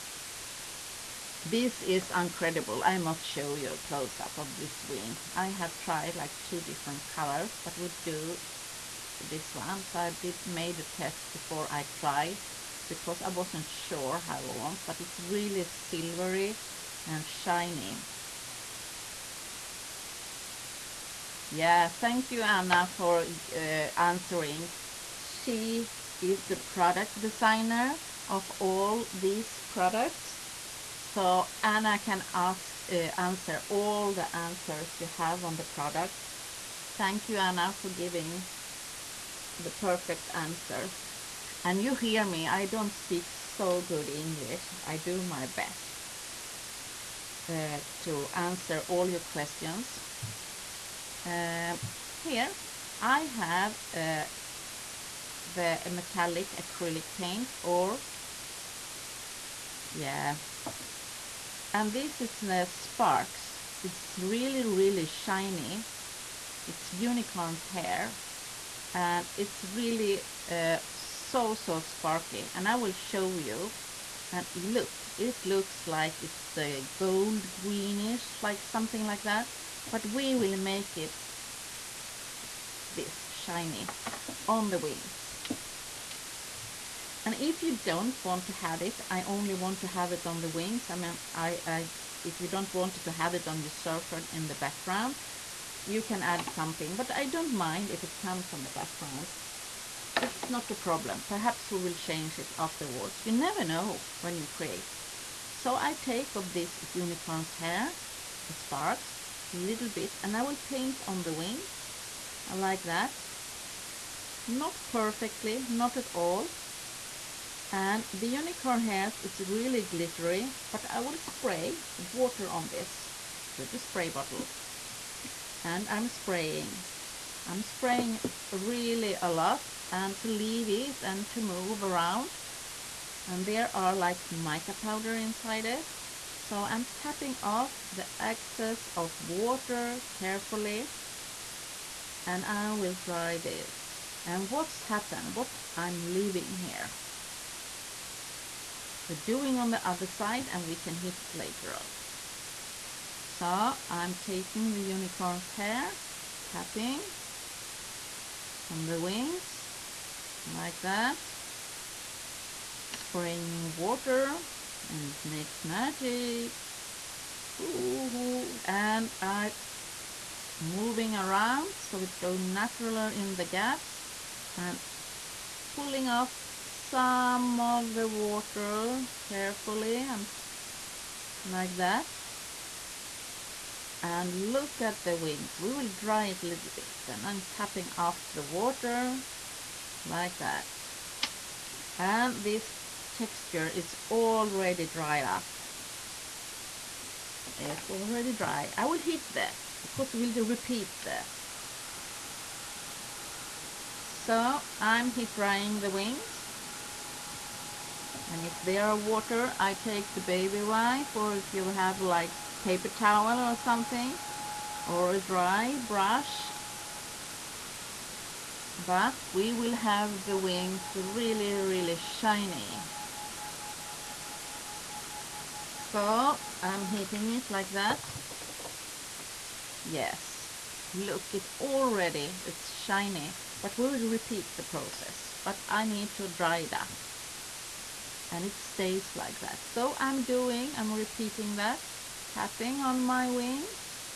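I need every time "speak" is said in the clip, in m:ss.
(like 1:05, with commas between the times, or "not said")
0:42.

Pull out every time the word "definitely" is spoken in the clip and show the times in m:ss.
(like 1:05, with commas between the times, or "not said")
not said.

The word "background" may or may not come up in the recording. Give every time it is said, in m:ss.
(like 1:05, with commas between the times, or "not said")
1:34, 1:38.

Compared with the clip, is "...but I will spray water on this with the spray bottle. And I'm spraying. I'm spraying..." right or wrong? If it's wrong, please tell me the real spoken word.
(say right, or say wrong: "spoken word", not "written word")
right.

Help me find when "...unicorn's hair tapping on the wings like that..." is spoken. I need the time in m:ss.
2:34.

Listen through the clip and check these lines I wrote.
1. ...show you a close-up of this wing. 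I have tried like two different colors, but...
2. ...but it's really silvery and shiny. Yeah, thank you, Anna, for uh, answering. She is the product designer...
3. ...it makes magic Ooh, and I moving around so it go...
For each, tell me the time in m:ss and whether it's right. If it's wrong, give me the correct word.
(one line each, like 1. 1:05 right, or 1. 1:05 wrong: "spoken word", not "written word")
1. 0:03 right
2. 0:14 right
3. 2:45 right.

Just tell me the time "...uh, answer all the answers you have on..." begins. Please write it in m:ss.
0:32.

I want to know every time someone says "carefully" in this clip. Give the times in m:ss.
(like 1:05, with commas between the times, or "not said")
2:20, 2:59.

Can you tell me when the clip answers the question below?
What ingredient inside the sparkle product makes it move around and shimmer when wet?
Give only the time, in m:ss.
2:14.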